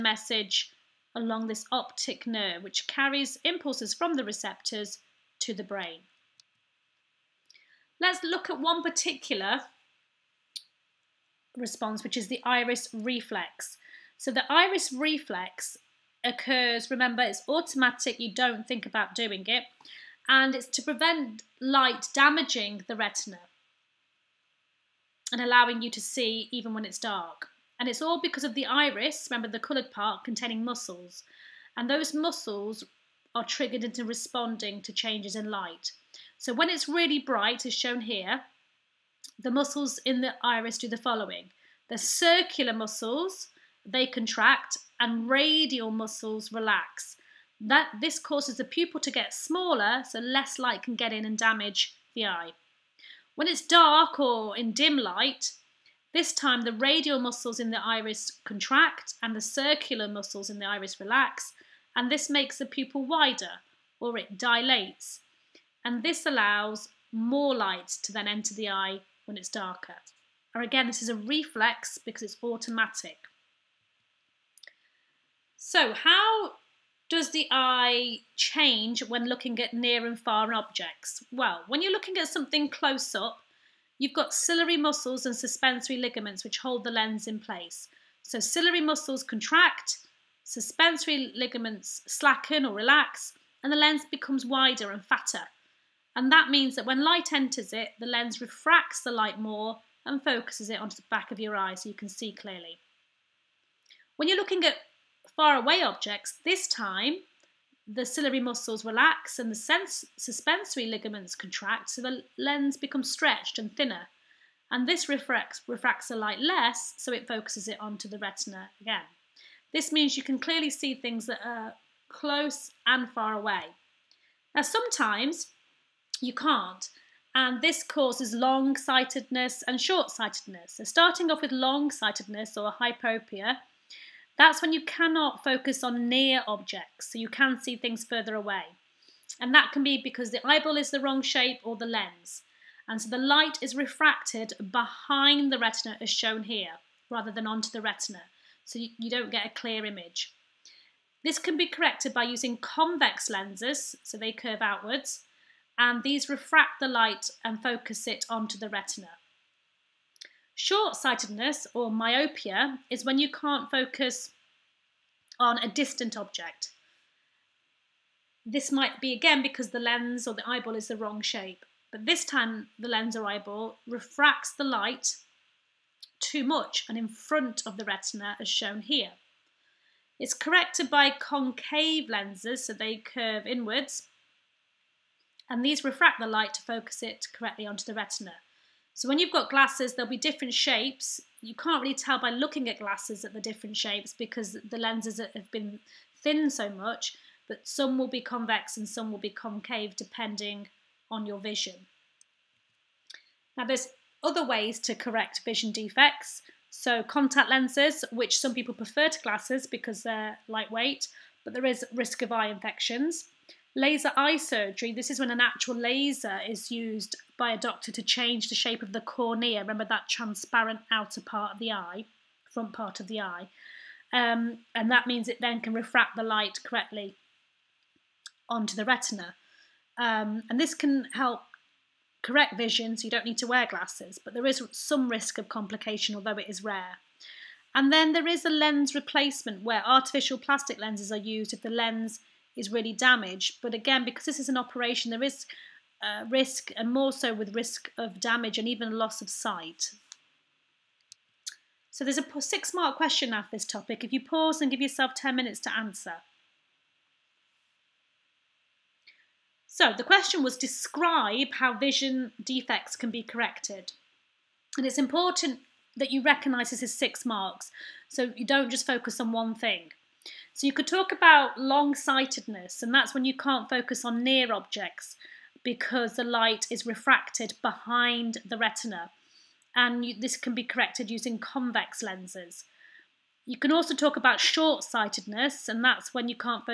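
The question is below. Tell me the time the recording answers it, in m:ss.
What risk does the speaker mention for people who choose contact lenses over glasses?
3:32.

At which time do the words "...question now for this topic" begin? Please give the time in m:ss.
4:12.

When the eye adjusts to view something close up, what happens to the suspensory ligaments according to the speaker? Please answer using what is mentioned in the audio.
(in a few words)
Slacken or relax.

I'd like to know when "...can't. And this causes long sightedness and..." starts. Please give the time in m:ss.
2:06.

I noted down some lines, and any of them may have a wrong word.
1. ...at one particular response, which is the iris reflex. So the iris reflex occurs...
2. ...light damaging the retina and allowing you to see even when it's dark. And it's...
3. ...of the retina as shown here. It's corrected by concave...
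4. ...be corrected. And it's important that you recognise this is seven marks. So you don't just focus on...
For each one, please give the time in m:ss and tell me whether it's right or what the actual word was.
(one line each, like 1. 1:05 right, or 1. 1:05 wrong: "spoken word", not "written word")
1. 0:08 right
2. 0:21 right
3. 2:57 right
4. 4:23 wrong: "six", not "seven".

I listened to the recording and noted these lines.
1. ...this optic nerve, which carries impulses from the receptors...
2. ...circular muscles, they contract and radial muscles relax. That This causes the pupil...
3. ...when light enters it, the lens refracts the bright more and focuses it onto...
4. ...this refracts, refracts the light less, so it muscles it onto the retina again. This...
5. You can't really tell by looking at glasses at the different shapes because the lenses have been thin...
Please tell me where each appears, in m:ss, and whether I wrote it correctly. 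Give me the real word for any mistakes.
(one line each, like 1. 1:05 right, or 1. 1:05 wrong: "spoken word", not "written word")
1. 0:01 right
2. 0:41 right
3. 1:36 wrong: "light", not "bright"
4. 1:54 wrong: "focuses", not "muscles"
5. 3:11 right.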